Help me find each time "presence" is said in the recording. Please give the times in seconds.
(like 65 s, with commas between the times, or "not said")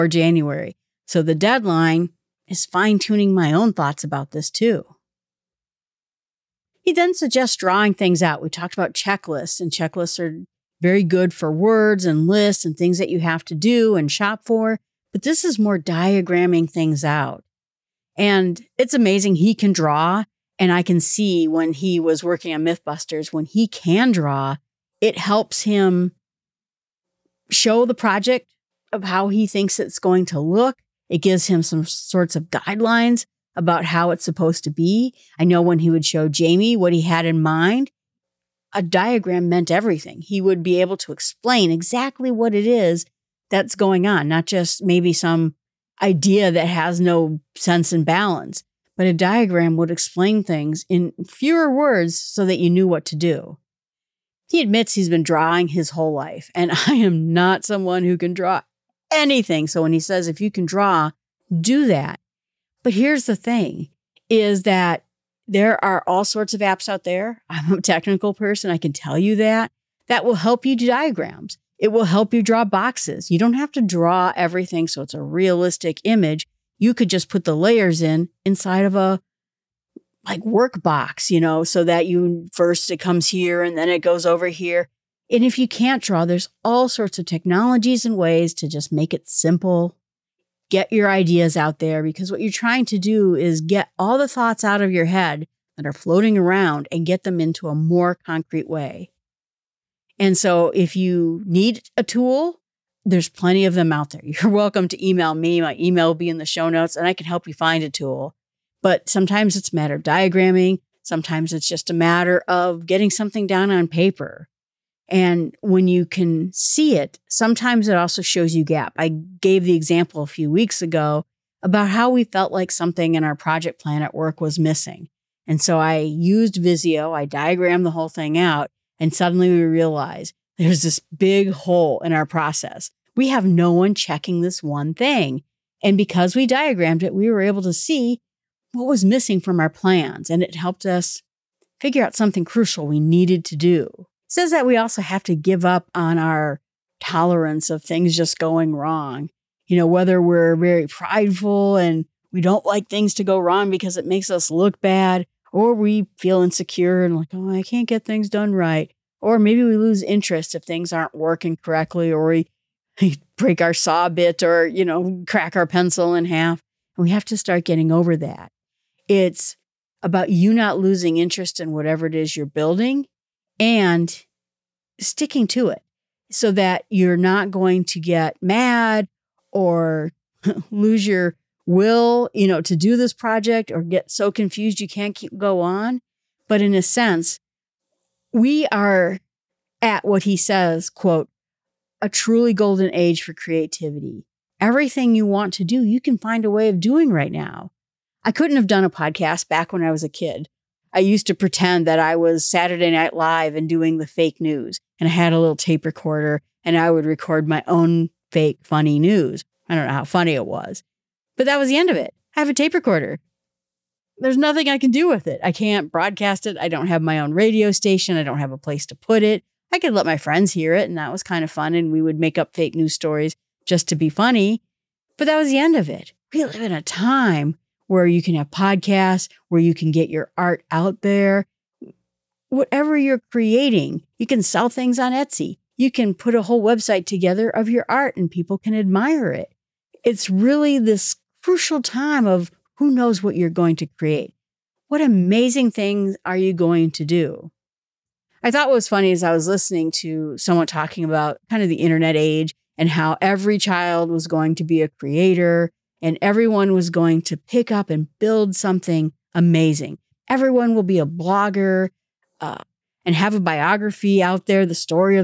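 not said.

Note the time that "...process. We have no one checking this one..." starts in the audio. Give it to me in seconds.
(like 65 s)
132 s.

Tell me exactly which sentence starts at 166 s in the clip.
we have to start getting over that.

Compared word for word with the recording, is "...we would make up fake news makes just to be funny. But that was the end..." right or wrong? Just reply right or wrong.
wrong.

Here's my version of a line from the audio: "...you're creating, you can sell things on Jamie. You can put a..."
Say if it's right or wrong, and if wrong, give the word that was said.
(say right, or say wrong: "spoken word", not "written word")
wrong: "Etsy", not "Jamie".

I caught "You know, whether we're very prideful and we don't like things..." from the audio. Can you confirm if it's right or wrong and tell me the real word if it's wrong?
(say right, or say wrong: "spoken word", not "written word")
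right.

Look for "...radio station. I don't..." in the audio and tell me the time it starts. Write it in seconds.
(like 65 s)
217 s.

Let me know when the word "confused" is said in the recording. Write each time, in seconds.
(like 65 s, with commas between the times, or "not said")
184 s.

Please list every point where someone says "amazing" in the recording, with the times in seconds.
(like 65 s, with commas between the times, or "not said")
18 s, 245 s, 259 s.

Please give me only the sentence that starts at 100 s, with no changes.
And so if you need a tool, there's plenty of them out there.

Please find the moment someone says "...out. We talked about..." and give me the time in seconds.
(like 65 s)
8 s.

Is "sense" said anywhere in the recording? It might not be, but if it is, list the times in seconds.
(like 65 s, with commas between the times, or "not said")
47 s, 186 s.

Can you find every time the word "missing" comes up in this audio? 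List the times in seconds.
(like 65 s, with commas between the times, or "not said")
124 s, 139 s.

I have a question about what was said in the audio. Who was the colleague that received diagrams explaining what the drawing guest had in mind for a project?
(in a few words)
Jamie.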